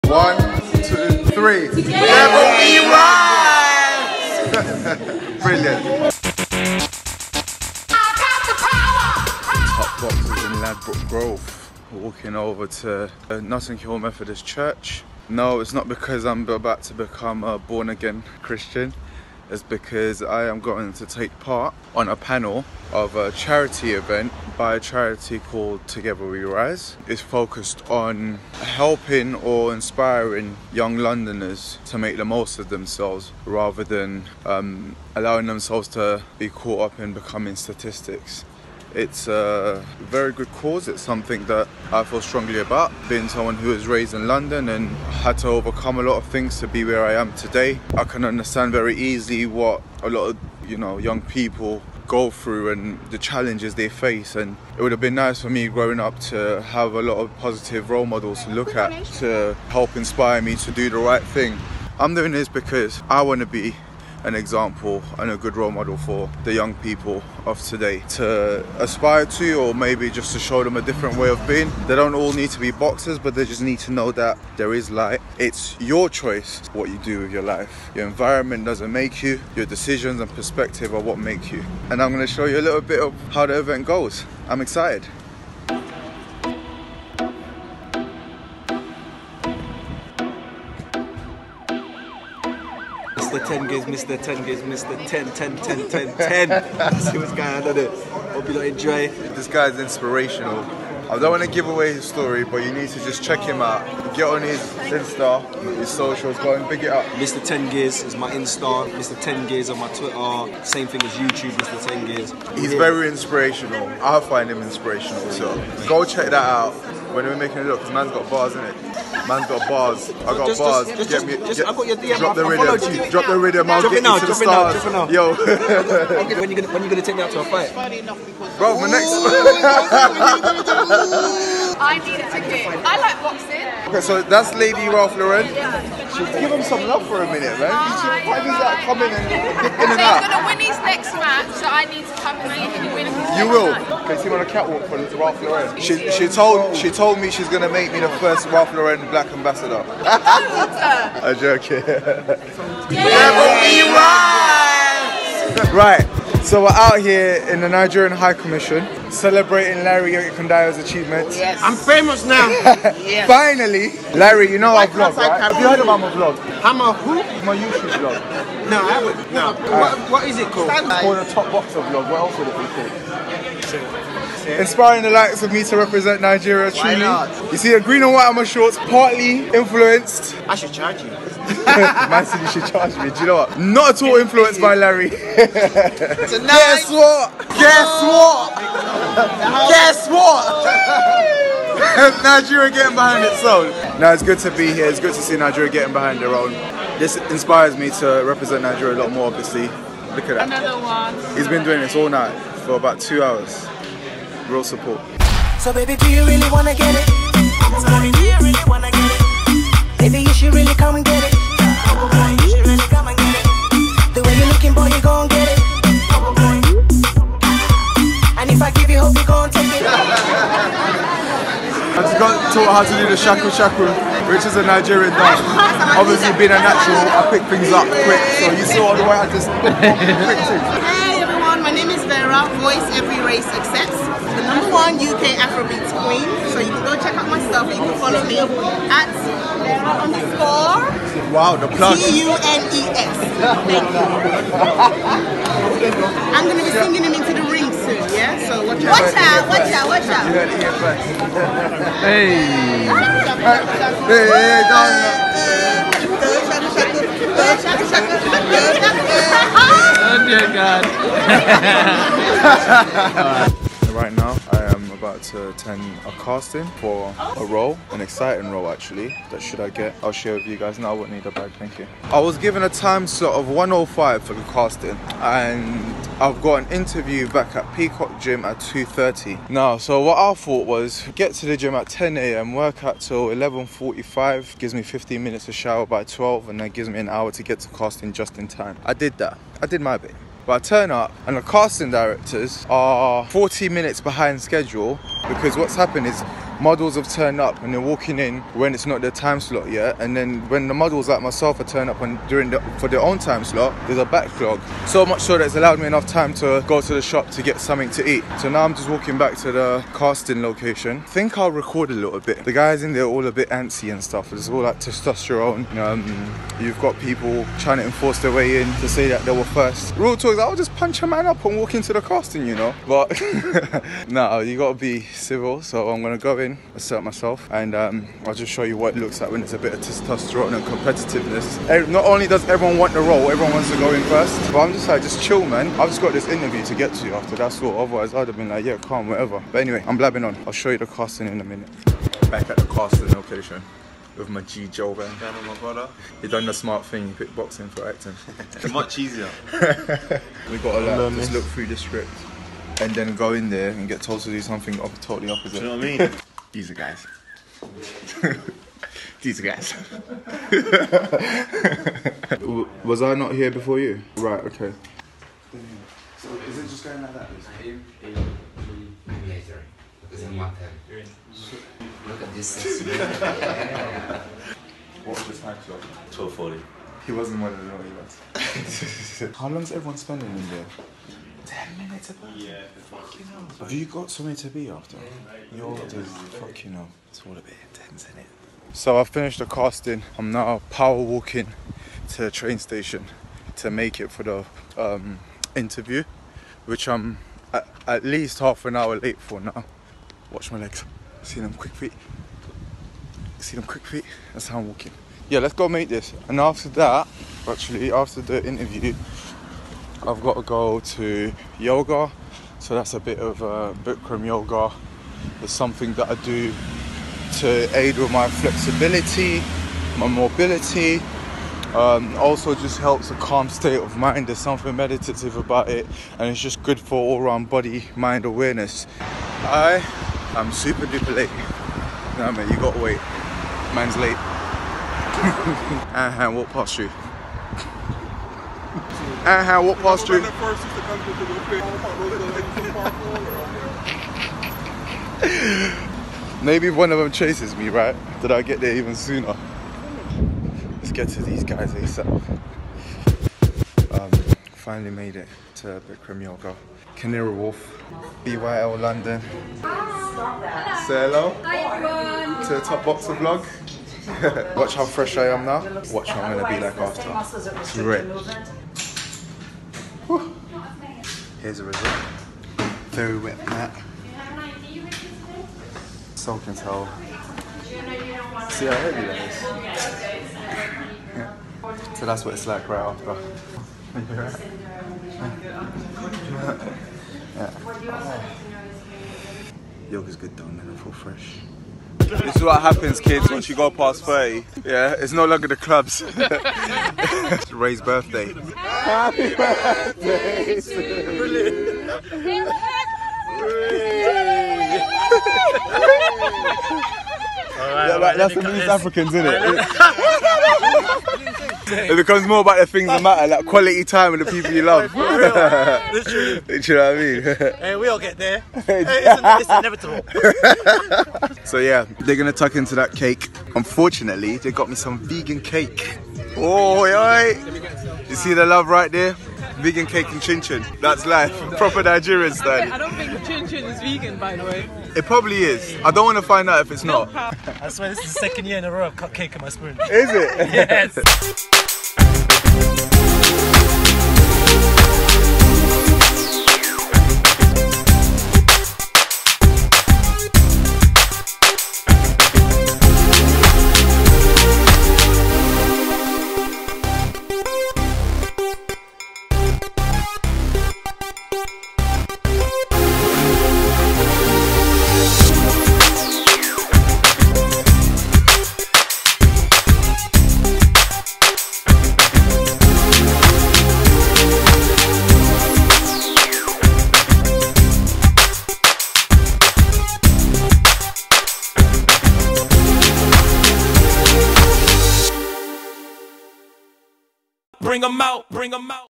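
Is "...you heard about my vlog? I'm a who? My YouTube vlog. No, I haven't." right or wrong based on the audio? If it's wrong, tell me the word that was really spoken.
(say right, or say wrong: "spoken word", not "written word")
right.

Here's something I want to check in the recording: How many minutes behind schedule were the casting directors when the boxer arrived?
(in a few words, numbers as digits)
40.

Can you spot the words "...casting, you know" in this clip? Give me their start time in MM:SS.
05:22.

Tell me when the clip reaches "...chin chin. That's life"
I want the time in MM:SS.
08:50.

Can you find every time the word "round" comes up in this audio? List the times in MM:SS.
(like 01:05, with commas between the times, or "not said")
07:07.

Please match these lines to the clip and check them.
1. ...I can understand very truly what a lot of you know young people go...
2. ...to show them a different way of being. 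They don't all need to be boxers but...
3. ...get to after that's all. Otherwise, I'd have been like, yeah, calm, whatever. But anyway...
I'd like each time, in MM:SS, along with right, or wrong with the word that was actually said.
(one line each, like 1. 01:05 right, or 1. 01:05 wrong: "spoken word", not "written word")
1. 00:47 wrong: "easily", not "truly"
2. 01:10 right
3. 05:36 right.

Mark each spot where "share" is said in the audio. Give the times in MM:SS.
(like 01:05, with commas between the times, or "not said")
04:30.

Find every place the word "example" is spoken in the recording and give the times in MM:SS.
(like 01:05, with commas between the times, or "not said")
01:04.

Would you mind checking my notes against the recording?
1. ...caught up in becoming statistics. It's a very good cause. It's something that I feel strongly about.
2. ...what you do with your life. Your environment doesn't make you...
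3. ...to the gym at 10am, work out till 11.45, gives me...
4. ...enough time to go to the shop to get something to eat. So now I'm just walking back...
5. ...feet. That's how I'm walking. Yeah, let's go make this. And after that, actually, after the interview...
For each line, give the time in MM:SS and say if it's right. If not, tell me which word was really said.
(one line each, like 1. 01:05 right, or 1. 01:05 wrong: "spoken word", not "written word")
1. 00:36 right
2. 01:16 right
3. 04:41 right
4. 05:05 right
5. 06:43 right.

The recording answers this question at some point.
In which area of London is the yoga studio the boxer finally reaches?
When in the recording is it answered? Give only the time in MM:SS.
07:36.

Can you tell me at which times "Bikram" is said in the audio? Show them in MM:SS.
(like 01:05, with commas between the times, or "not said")
06:53, 07:35.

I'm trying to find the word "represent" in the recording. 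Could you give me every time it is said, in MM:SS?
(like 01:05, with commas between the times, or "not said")
02:55, 03:18.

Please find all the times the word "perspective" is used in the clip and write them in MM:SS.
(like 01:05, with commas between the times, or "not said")
01:20.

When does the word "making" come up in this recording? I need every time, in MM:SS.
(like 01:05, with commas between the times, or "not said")
01:57.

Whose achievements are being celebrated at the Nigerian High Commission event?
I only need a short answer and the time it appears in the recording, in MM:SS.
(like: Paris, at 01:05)
Larry Ekundayo, at 02:39.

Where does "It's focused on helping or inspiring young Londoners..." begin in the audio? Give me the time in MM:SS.
00:27.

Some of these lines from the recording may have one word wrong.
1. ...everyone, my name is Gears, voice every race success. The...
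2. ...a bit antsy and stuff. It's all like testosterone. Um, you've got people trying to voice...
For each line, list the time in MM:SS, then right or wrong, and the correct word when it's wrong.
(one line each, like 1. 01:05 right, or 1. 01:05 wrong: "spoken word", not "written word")
1. 03:51 wrong: "Vera", not "Gears"
2. 05:13 wrong: "enforce", not "voice".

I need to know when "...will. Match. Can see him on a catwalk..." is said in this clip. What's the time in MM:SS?
02:23.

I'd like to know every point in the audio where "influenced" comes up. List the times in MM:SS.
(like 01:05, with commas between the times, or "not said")
02:59, 03:04.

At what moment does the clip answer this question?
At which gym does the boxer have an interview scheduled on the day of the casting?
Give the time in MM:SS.
04:37.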